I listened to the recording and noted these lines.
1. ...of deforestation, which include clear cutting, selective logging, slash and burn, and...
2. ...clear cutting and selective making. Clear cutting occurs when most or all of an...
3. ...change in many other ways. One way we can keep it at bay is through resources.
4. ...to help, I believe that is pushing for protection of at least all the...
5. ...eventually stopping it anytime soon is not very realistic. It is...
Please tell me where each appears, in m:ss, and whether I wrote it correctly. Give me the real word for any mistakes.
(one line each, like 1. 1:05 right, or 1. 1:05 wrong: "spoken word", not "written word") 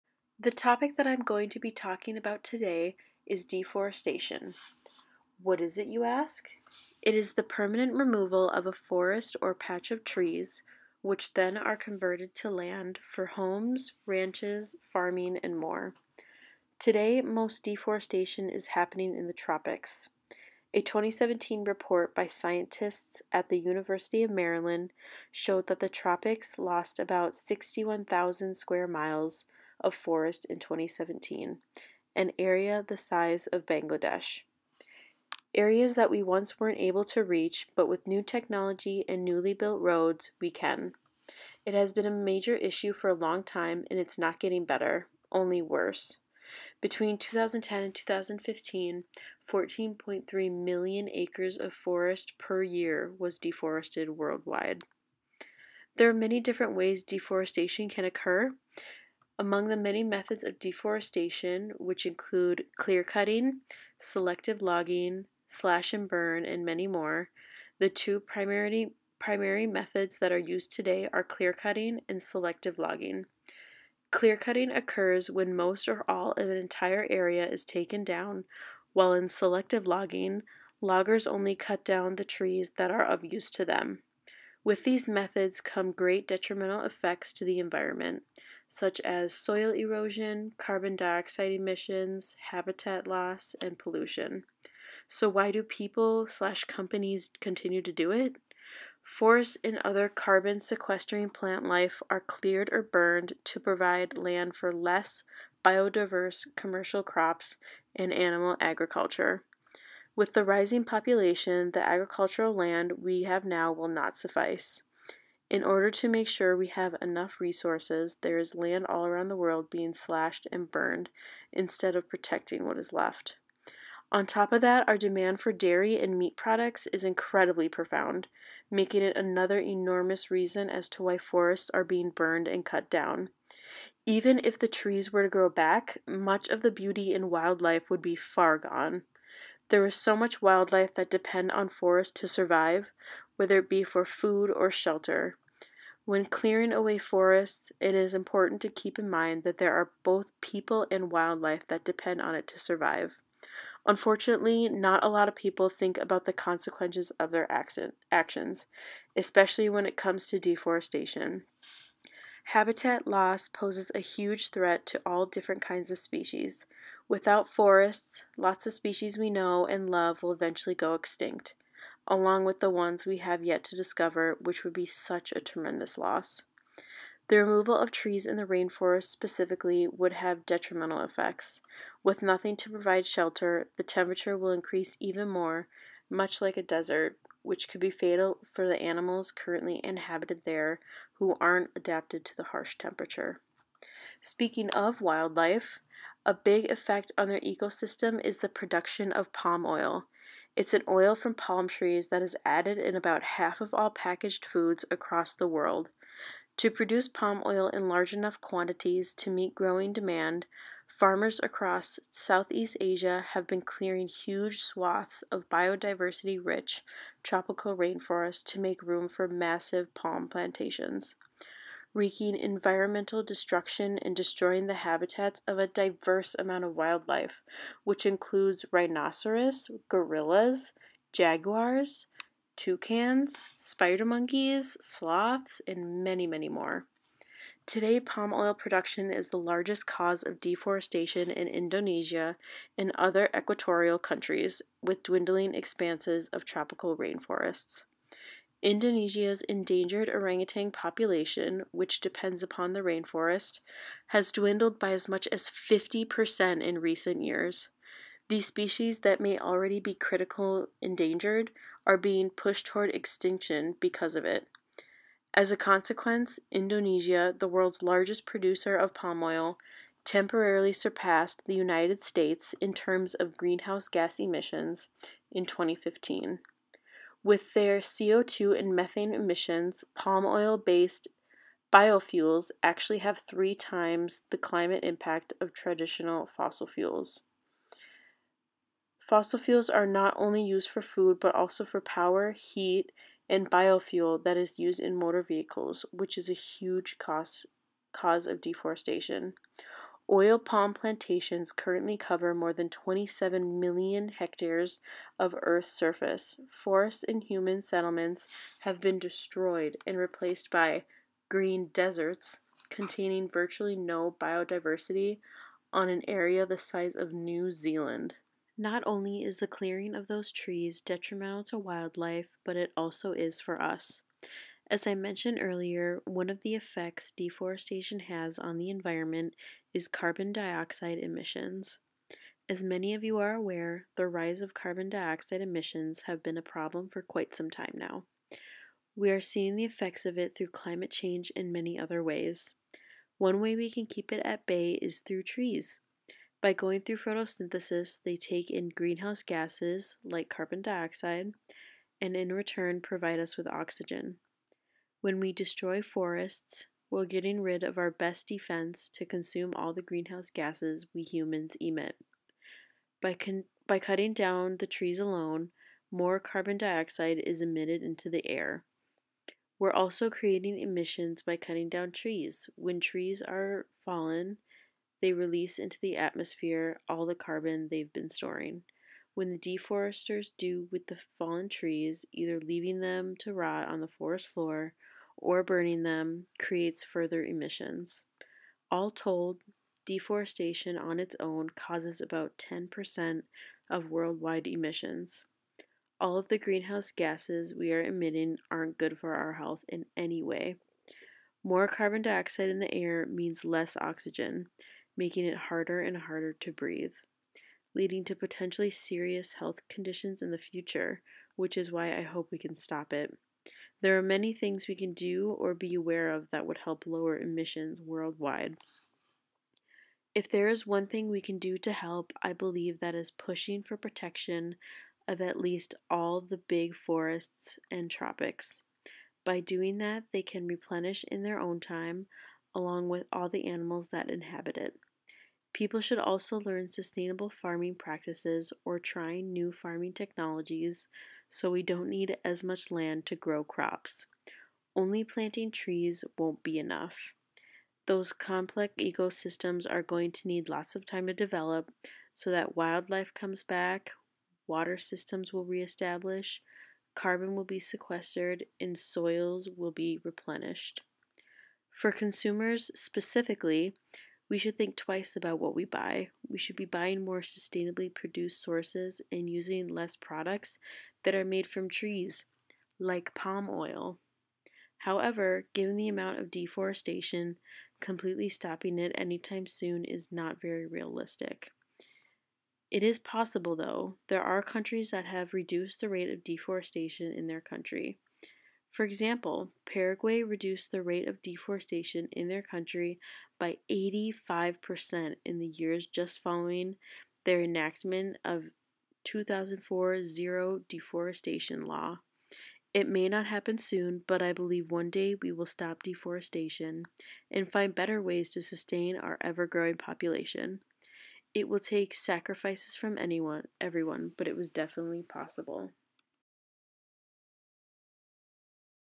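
1. 1:00 right
2. 1:11 wrong: "logging", not "making"
3. 5:40 wrong: "trees", not "resources"
4. 7:01 right
5. 7:57 wrong: "completely", not "eventually".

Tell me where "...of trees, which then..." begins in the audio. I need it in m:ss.
0:09.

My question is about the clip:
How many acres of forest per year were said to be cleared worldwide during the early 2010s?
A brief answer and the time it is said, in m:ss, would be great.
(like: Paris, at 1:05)
14.3 million, at 0:49.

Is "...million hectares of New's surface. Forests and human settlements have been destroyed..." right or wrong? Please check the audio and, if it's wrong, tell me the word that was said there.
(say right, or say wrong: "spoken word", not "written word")
wrong: "Earth", not "New".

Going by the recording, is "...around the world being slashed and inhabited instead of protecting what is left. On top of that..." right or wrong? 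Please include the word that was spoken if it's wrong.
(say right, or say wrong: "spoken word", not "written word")
wrong: "burned", not "inhabited".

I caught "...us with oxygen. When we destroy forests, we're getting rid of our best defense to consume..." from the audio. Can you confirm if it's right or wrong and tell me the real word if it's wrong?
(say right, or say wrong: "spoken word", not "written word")
right.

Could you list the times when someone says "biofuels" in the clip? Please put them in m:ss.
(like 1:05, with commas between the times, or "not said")
4:41, 4:53.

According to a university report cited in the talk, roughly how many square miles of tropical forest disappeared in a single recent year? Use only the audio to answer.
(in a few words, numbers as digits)
61,000.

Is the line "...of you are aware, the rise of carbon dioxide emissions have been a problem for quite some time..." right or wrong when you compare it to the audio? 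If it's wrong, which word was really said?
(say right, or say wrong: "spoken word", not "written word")
right.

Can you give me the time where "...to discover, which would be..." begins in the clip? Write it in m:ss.
2:53.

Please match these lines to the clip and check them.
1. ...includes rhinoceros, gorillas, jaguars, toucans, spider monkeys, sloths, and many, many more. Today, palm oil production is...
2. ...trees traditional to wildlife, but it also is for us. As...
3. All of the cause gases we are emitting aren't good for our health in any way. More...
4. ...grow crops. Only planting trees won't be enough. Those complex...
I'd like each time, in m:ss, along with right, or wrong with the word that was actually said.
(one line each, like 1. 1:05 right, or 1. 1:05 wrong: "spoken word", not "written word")
1. 3:48 right
2. 5:20 wrong: "detrimental", not "traditional"
3. 6:35 wrong: "greenhouse", not "cause"
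4. 7:23 right.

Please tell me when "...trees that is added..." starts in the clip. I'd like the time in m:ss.
3:21.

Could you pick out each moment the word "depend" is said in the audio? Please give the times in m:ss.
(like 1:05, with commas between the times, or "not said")
2:21, 2:31, 4:11.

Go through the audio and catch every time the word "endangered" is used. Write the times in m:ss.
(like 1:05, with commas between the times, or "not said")
4:09, 4:20.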